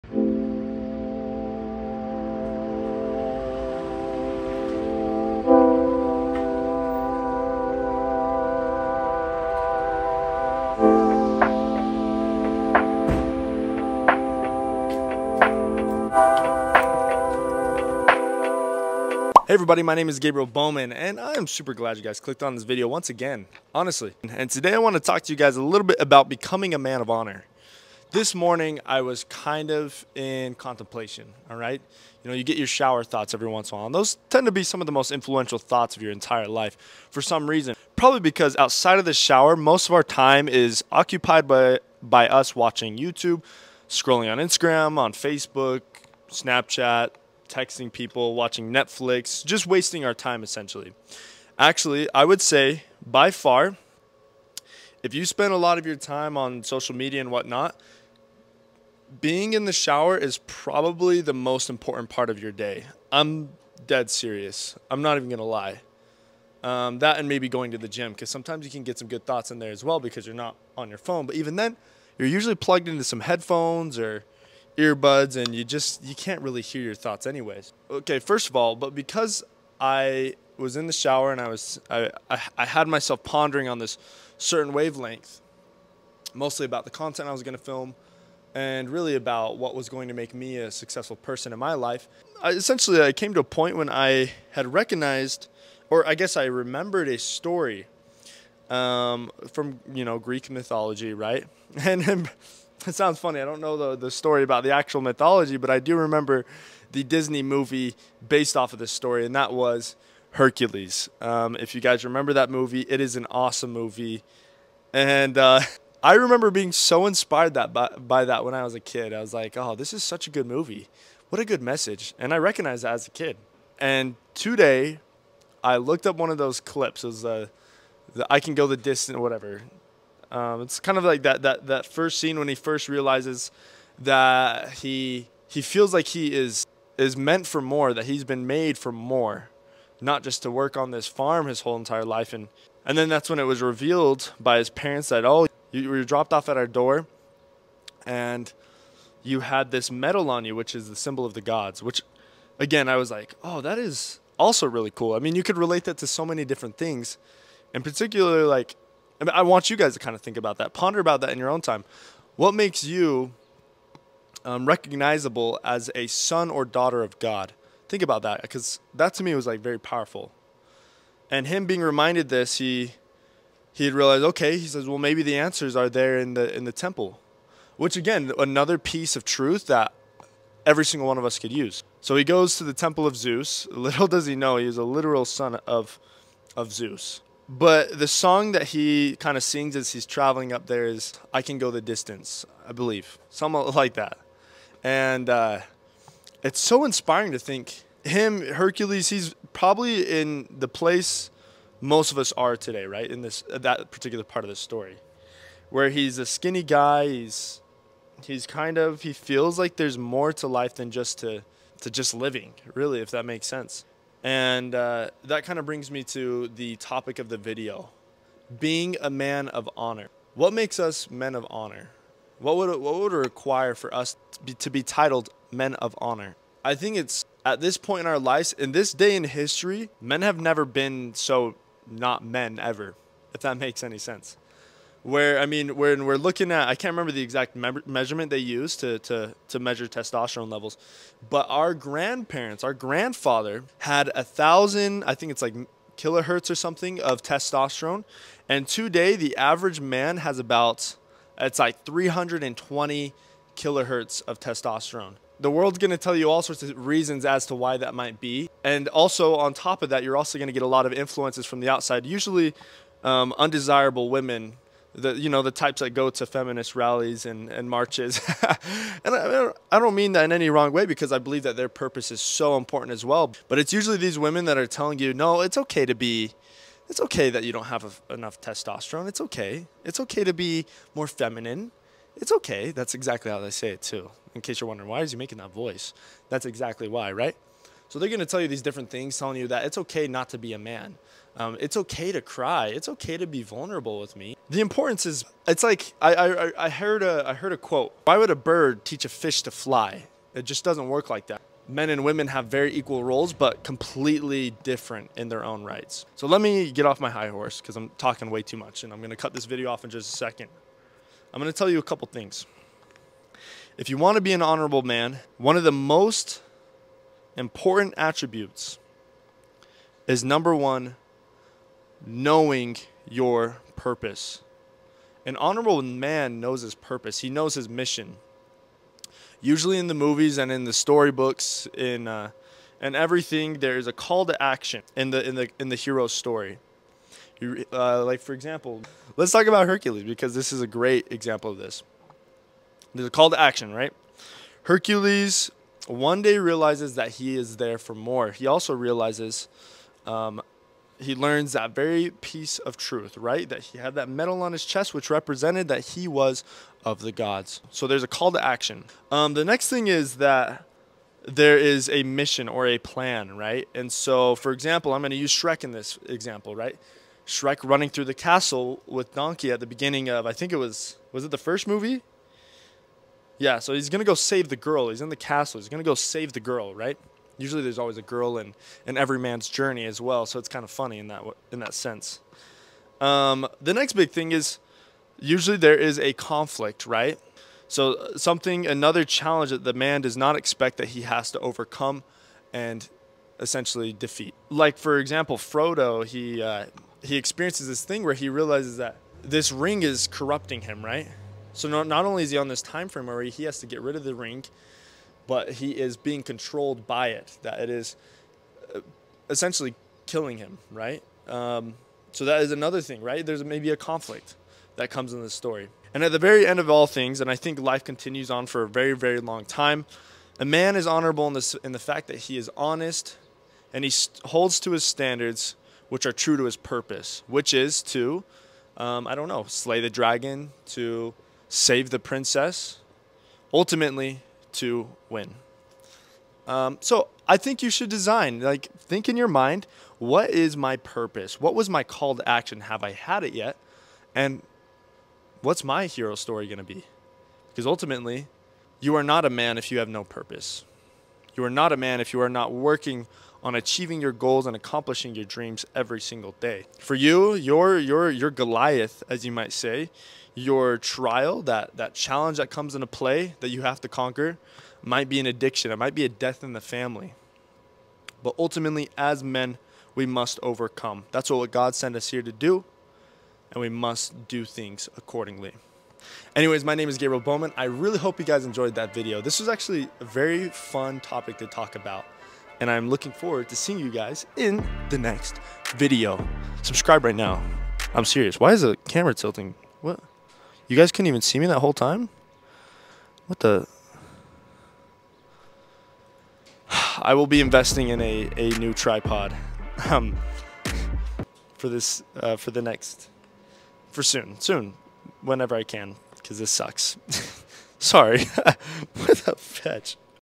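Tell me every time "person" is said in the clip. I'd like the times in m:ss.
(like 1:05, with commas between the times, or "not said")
1:31.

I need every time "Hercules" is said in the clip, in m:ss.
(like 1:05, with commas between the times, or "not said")
1:50, 3:18, 5:39, 5:44.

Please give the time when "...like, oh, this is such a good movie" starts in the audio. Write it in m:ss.
1:59.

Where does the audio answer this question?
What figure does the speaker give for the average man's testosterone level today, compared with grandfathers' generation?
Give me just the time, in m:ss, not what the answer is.
4:11.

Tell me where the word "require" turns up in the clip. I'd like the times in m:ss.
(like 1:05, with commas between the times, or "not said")
3:43.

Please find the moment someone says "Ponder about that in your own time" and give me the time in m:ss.
2:40.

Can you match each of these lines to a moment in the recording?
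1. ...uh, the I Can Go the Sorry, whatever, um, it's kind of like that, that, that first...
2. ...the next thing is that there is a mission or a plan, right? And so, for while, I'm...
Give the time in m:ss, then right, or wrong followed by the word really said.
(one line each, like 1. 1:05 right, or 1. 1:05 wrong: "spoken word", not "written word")
1. 2:07 wrong: "Distance", not "Sorry"
2. 5:59 wrong: "example", not "while".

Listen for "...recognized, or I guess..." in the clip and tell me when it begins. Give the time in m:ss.
1:34.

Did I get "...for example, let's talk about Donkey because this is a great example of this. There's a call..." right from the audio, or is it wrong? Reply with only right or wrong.
wrong.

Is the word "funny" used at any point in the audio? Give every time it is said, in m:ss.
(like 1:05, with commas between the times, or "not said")
1:43, 6:20.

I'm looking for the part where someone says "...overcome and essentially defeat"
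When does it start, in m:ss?
6:31.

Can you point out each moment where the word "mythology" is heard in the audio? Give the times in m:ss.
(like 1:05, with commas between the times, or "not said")
1:40, 1:45.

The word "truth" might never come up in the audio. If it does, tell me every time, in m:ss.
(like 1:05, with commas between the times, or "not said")
2:59, 5:52.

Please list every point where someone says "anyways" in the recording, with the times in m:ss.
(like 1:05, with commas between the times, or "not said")
1:17, 7:56.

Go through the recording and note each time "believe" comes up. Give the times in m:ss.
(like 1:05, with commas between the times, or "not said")
3:12, 4:31.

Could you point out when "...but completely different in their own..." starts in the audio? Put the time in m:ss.
5:03.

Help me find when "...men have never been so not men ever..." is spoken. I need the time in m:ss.
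3:49.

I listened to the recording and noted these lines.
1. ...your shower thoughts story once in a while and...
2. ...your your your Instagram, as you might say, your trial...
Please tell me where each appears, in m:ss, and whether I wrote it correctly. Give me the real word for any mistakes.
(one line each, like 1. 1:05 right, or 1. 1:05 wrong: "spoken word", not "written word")
1. 0:32 wrong: "every", not "story"
2. 7:37 wrong: "Goliath", not "Instagram".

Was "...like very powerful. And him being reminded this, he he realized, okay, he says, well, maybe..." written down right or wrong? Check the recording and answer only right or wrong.
right.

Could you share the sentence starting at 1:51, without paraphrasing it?
Um, if you guys remember that movie, it is an awesome movie.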